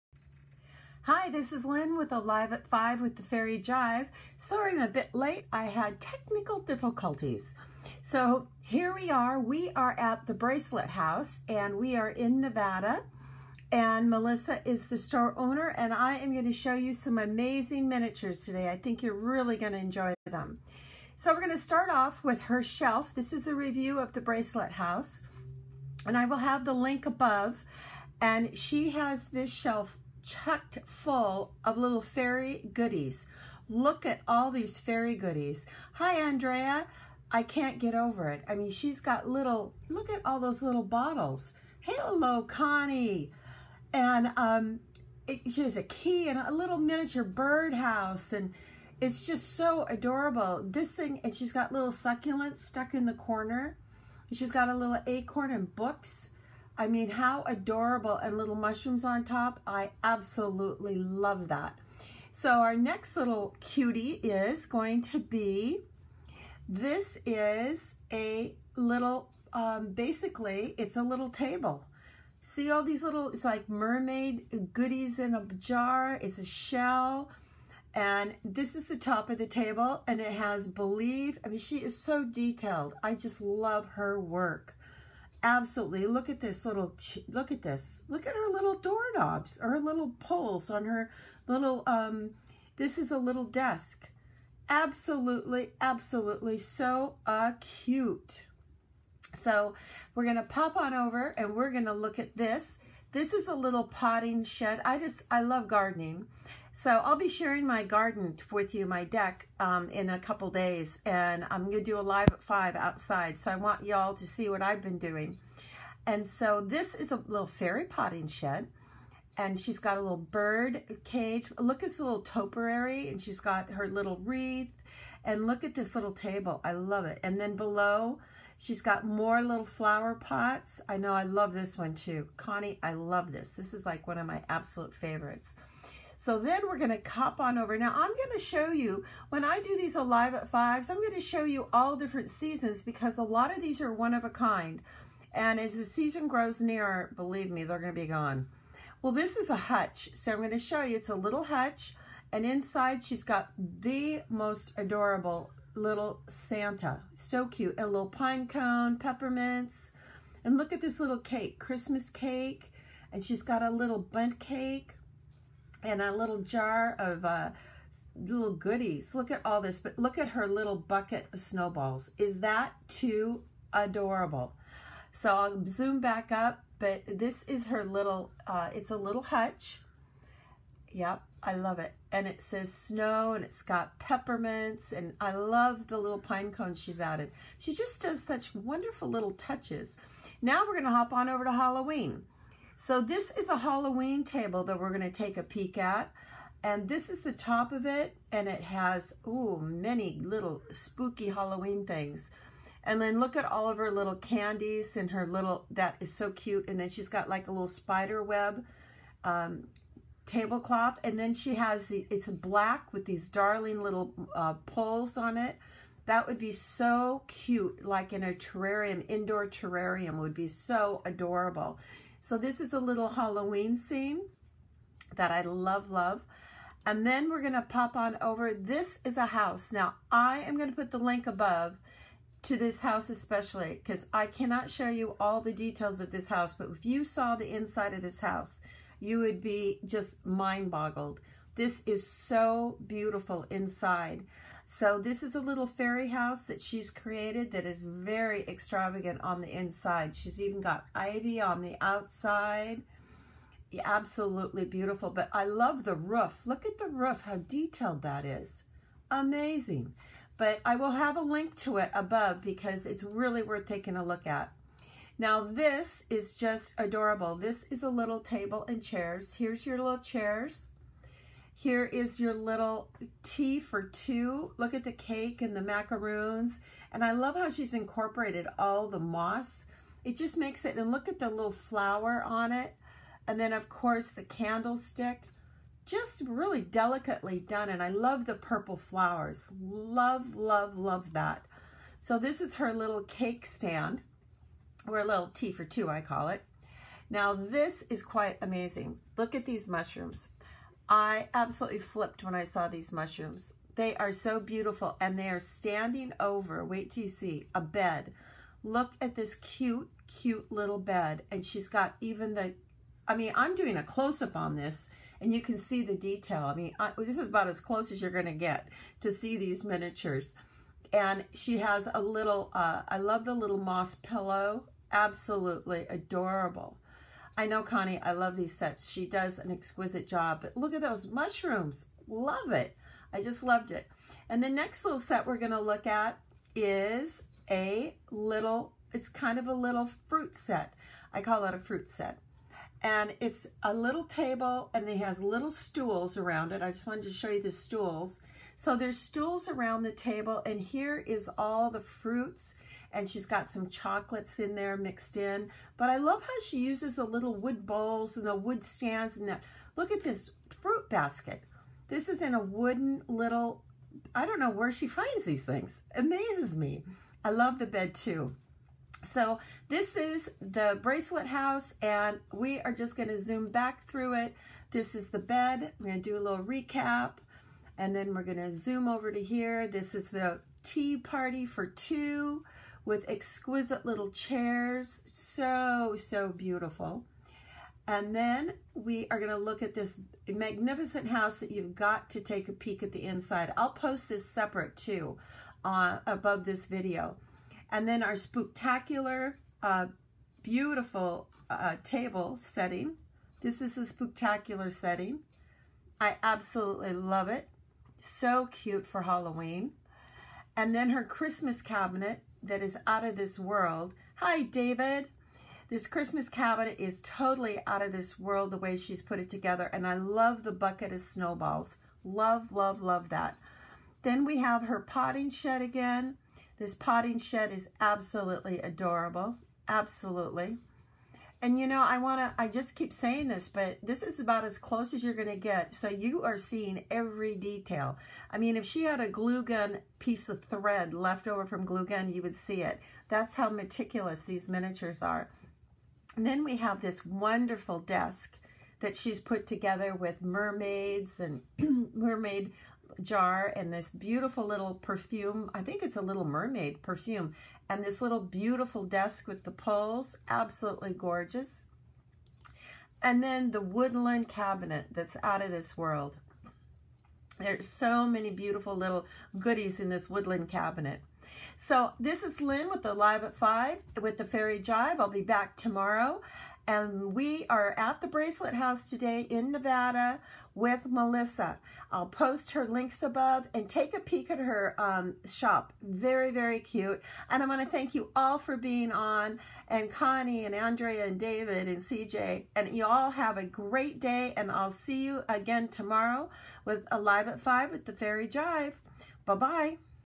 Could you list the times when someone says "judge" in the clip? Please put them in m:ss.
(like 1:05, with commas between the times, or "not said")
not said.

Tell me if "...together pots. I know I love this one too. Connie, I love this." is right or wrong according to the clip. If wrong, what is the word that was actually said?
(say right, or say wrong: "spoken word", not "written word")
wrong: "flower", not "together".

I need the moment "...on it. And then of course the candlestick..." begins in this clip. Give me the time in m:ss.
4:42.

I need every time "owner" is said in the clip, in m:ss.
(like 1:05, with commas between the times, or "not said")
0:15.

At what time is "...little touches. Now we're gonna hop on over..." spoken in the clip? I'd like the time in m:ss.
3:09.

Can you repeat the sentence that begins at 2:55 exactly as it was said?
So I'll zoom back up, but this is her little, uh, it's a little hutch.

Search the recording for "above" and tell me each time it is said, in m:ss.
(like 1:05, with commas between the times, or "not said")
0:27, 3:51, 4:21, 6:36, 8:03.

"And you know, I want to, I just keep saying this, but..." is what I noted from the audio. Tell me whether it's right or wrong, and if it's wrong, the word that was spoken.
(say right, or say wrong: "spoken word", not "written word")
right.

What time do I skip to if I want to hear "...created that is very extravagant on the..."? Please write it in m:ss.
4:06.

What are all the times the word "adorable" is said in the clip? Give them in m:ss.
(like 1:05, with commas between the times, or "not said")
0:49, 0:57, 2:34, 2:53, 3:41, 4:26, 5:25, 7:08.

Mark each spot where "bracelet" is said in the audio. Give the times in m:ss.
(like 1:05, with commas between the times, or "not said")
0:10, 0:24, 6:10, 7:58.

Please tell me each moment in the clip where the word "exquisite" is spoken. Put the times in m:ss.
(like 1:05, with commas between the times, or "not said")
5:29, 6:23.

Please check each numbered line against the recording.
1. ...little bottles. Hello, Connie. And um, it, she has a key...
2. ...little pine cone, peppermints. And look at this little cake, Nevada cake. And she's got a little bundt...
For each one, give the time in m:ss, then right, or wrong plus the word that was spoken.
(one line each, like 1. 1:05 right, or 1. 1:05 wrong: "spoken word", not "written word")
1. 0:40 right
2. 2:37 wrong: "Christmas", not "Nevada".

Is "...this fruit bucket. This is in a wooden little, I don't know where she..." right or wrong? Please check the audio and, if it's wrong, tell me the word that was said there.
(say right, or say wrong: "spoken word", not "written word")
wrong: "basket", not "bucket".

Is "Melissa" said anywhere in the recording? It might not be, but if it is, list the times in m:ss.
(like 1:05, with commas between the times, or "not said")
0:14, 8:00.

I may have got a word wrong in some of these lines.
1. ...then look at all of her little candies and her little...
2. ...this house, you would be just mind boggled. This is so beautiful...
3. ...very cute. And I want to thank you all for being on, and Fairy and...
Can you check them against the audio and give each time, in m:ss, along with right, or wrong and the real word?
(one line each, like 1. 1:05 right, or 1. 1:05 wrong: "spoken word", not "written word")
1. 3:22 right
2. 3:58 right
3. 8:06 wrong: "Connie", not "Fairy".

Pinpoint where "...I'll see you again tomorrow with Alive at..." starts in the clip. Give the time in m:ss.
8:14.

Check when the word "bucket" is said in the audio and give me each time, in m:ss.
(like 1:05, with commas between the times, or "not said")
2:50, 7:00.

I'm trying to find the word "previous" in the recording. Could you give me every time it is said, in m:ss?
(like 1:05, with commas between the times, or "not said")
not said.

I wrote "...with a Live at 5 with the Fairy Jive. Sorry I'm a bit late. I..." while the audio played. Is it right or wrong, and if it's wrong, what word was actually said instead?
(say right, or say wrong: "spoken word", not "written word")
right.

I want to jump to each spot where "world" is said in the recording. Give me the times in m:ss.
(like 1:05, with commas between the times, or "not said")
6:53, 6:58, 7:45.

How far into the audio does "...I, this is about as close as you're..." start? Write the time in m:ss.
5:16.